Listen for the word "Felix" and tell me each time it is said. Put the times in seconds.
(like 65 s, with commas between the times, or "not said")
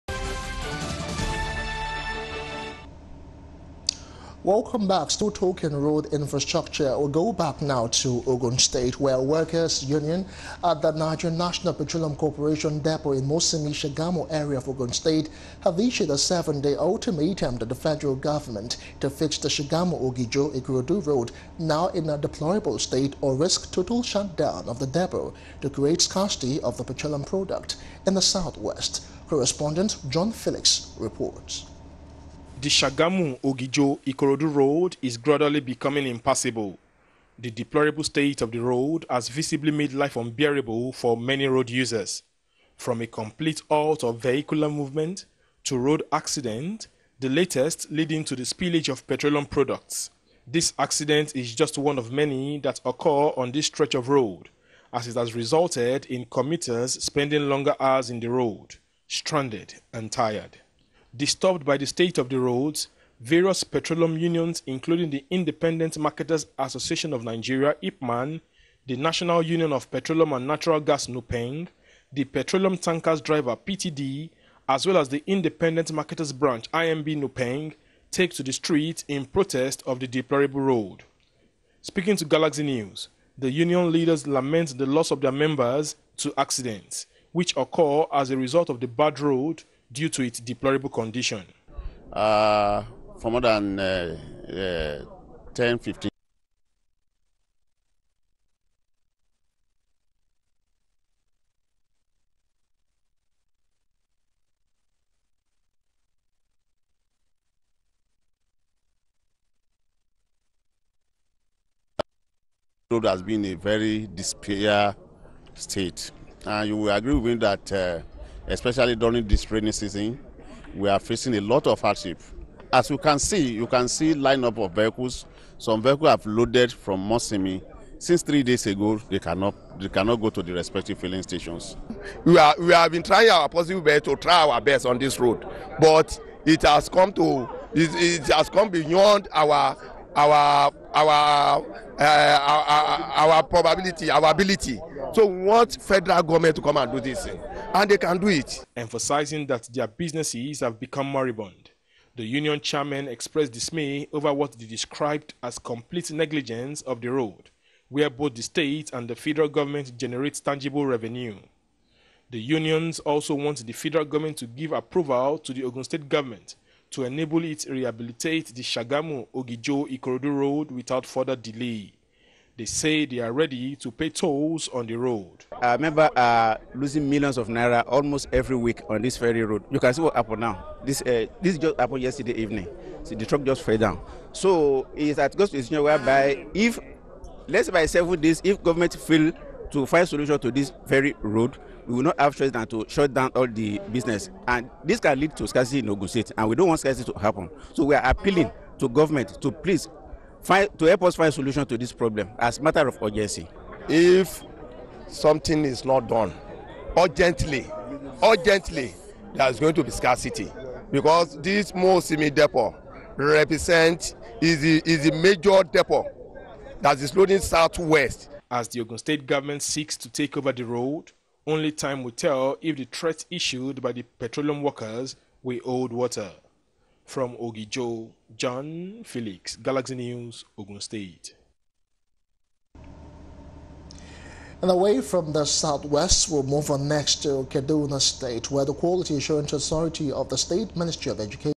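30 s, 229 s.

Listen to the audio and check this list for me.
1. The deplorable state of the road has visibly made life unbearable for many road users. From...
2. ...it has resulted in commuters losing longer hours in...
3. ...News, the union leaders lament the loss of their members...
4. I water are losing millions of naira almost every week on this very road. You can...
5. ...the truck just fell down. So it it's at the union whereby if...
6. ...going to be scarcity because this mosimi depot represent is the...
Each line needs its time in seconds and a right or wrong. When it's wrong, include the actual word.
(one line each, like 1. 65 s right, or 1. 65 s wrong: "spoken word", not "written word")
1. 37 s right
2. 55 s wrong: "spending", not "losing"
3. 82 s right
4. 175 s wrong: "remember", not "water"
5. 183 s wrong: "decision", not "union"
6. 209 s right.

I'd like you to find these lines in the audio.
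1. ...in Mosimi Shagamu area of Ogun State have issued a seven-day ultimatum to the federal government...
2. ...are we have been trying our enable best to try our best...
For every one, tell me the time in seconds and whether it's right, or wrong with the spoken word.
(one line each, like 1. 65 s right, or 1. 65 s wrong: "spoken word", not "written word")
1. 13 s right
2. 132 s wrong: "possible", not "enable".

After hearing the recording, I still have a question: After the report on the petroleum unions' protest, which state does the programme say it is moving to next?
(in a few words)
Kaduna State.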